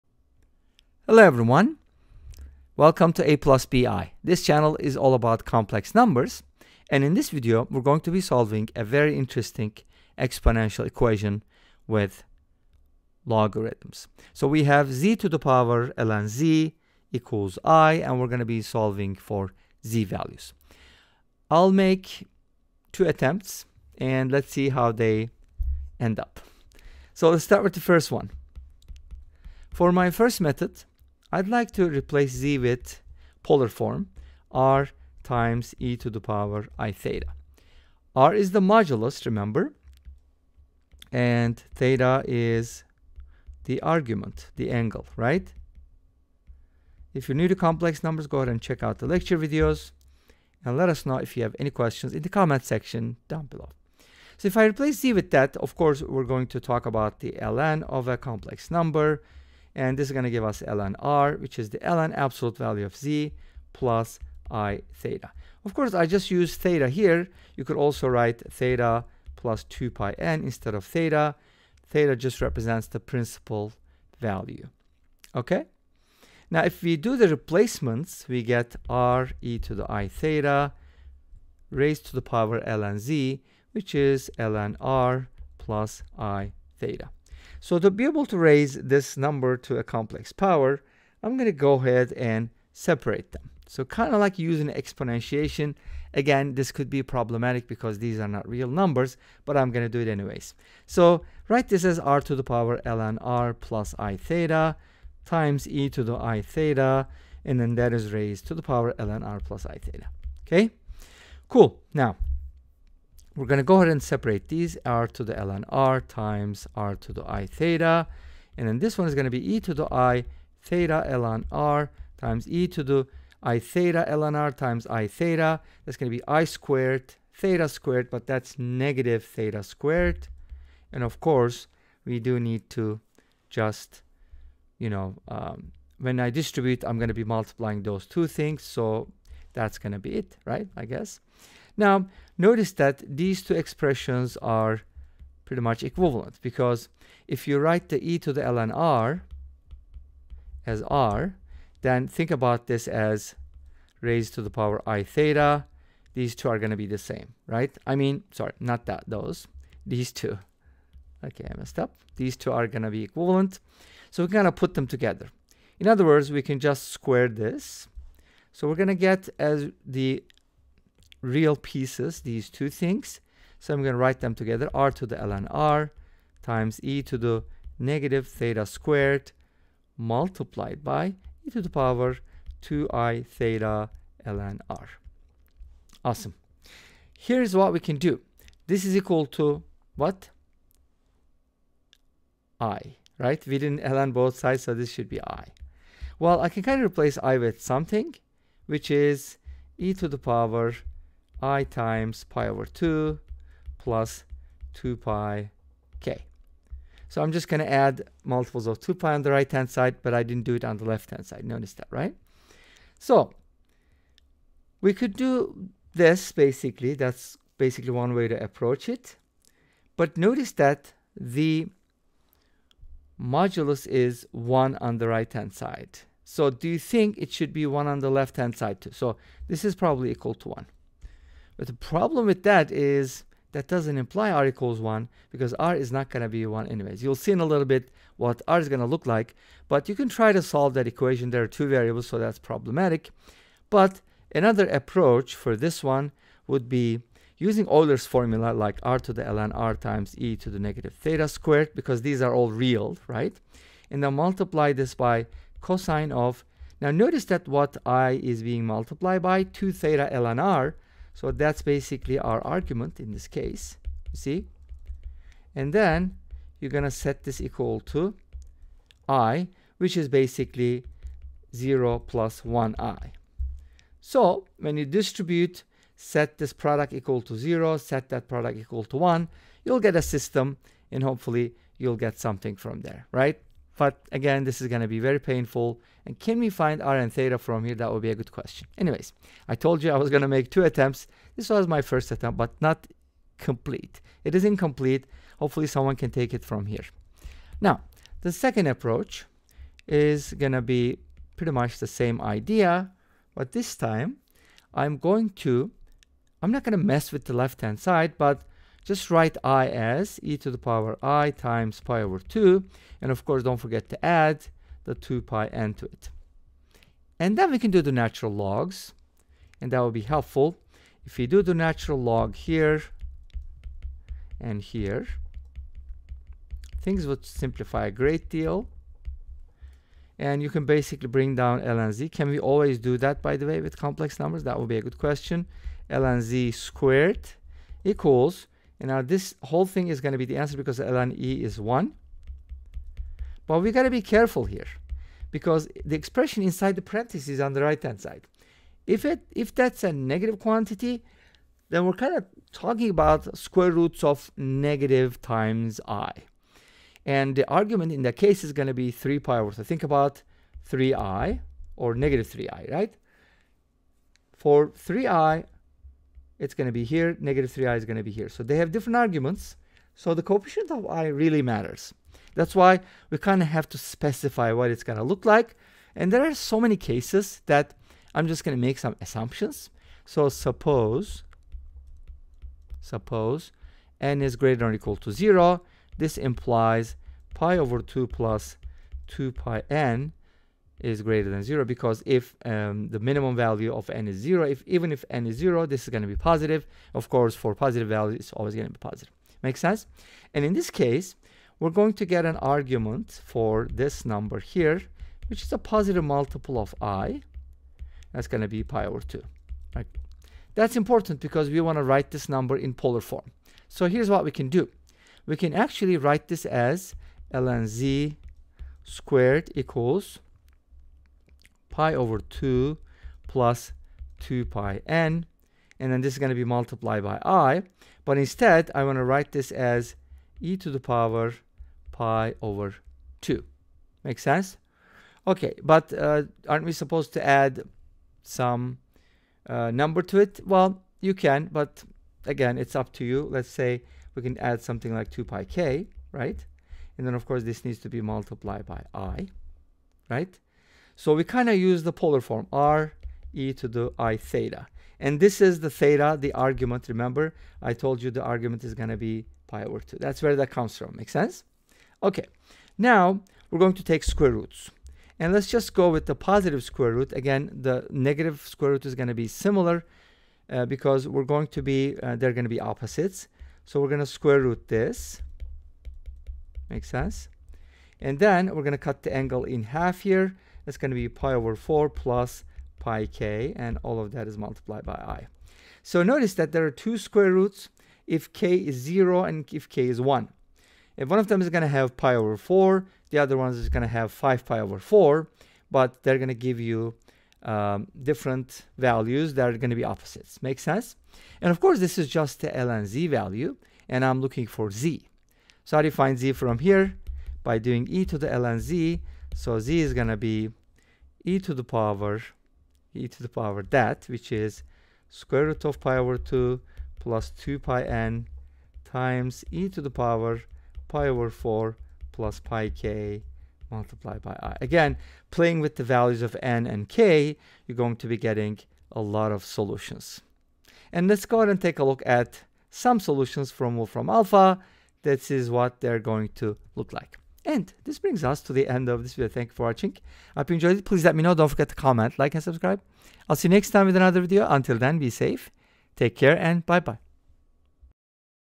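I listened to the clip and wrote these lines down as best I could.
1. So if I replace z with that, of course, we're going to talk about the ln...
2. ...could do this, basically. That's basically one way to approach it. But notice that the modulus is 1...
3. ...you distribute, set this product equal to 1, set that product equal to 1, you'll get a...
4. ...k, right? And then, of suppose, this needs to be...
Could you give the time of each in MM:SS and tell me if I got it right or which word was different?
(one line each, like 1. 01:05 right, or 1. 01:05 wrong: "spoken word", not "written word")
1. 00:54 right
2. 03:34 right
3. 04:34 wrong: "0", not "1"
4. 07:25 wrong: "course", not "suppose".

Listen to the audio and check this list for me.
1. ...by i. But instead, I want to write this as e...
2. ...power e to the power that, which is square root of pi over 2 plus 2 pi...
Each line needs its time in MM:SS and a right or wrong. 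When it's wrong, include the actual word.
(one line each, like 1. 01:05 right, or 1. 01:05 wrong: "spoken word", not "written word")
1. 07:07 right
2. 08:31 right.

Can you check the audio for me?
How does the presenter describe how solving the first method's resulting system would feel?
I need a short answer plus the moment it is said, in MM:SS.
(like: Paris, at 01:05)
very painful, at 04:44.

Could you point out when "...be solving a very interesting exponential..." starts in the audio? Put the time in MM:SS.
00:08.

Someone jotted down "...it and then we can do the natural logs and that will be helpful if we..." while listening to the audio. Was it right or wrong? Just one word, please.
right.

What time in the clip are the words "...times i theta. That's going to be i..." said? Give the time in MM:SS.
02:04.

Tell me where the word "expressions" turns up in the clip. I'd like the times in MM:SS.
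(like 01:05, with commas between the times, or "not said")
02:23, 05:45.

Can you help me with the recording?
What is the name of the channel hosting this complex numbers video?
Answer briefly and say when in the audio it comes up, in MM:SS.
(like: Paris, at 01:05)
A plus BI, at 00:03.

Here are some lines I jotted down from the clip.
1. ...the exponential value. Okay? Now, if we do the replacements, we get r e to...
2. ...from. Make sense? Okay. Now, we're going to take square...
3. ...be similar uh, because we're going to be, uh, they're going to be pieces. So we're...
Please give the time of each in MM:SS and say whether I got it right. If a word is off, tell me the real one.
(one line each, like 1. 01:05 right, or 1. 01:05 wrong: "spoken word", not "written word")
1. 01:12 wrong: "principal", not "exponential"
2. 07:40 right
3. 07:49 wrong: "opposites", not "pieces".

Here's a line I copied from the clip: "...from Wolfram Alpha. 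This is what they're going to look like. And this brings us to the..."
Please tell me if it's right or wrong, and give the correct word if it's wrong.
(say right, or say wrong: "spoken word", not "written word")
right.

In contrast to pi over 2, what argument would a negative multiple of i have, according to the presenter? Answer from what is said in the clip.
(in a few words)
3 pi over.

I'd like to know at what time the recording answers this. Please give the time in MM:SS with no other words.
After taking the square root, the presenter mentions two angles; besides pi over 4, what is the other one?
08:14.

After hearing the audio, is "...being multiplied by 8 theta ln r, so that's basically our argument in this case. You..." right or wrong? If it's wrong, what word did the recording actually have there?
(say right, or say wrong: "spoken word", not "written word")
wrong: "2", not "8".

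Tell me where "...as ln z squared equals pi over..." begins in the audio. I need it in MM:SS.
06:56.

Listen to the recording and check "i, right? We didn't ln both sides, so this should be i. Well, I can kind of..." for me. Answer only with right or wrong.
right.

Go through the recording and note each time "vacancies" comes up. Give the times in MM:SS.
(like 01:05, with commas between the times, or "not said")
not said.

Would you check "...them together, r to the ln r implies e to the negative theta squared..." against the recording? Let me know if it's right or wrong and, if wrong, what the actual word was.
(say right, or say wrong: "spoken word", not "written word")
wrong: "times", not "implies".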